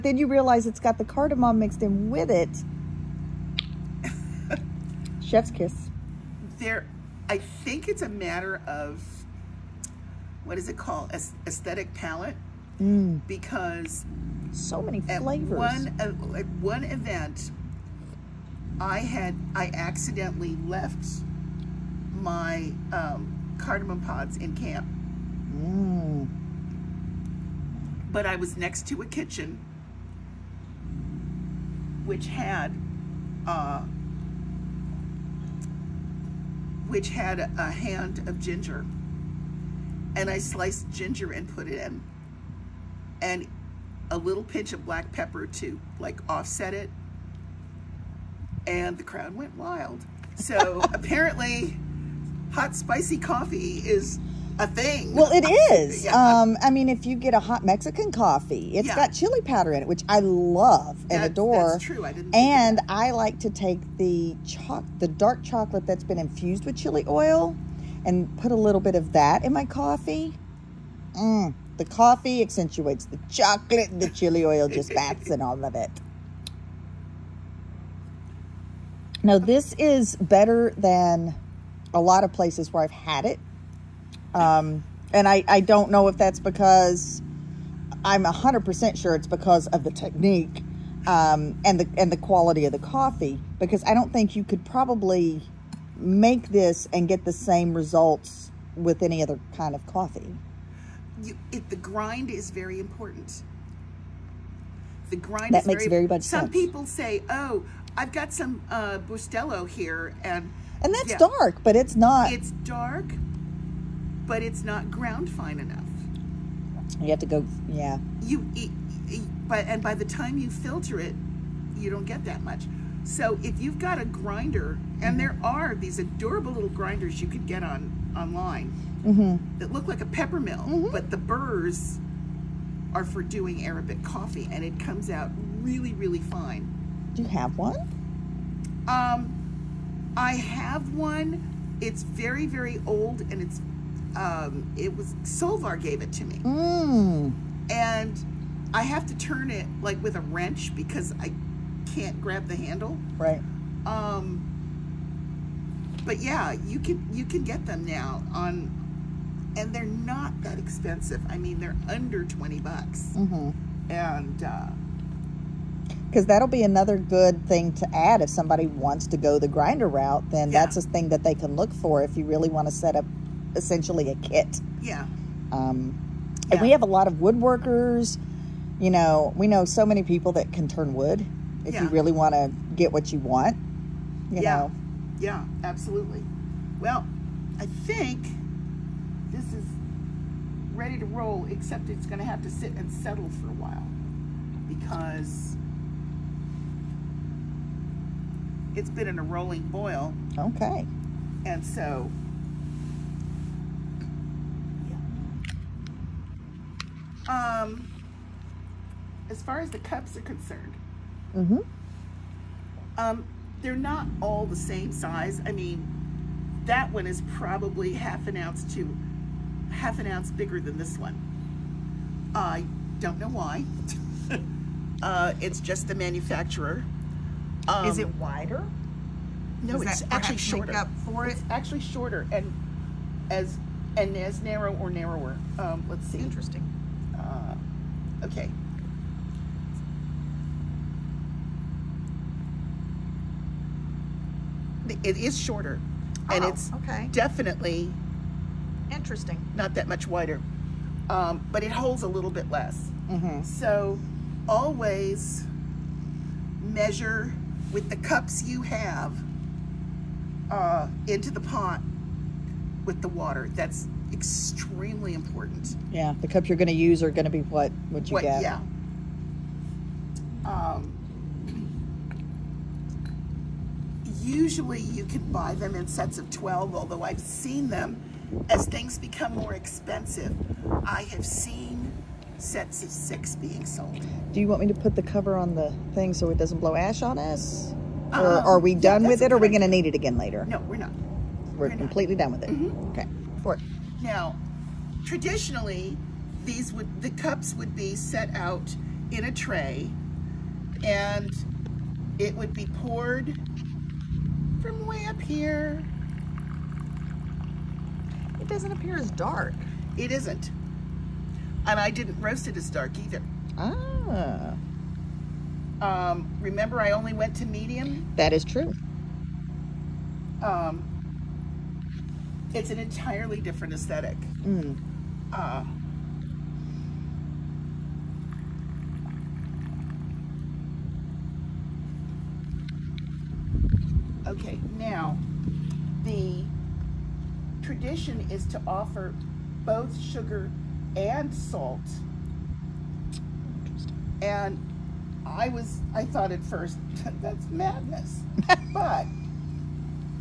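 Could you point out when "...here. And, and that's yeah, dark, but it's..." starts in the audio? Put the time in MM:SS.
01:49.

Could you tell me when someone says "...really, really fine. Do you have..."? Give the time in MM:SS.
02:15.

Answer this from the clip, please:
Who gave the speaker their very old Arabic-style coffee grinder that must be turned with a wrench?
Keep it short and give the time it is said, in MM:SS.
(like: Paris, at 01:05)
Solvar, at 02:25.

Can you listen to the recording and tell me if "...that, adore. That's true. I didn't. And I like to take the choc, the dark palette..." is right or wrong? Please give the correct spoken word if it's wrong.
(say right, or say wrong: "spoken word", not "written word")
wrong: "chocolate", not "palette".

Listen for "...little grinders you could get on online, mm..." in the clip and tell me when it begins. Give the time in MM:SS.
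02:06.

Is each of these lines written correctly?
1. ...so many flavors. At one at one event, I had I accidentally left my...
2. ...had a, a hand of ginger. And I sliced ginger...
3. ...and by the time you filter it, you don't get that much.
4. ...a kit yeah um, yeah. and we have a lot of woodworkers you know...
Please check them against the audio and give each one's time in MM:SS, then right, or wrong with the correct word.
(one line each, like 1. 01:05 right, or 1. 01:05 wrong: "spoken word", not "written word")
1. 00:14 right
2. 00:37 right
3. 01:59 right
4. 02:54 right.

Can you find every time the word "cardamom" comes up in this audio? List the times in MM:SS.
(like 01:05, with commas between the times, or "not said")
00:01, 00:23.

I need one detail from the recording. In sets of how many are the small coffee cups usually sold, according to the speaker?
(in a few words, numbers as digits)
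12.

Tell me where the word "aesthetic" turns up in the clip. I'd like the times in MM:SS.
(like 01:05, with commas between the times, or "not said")
00:11, 05:23.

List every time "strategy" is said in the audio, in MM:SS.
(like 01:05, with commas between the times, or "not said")
not said.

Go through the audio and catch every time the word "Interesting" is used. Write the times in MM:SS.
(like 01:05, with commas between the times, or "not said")
03:56, 04:08.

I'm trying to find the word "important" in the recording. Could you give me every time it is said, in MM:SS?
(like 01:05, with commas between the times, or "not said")
01:42, 04:25.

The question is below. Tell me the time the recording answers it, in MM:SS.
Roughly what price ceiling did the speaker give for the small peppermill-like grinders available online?
02:41.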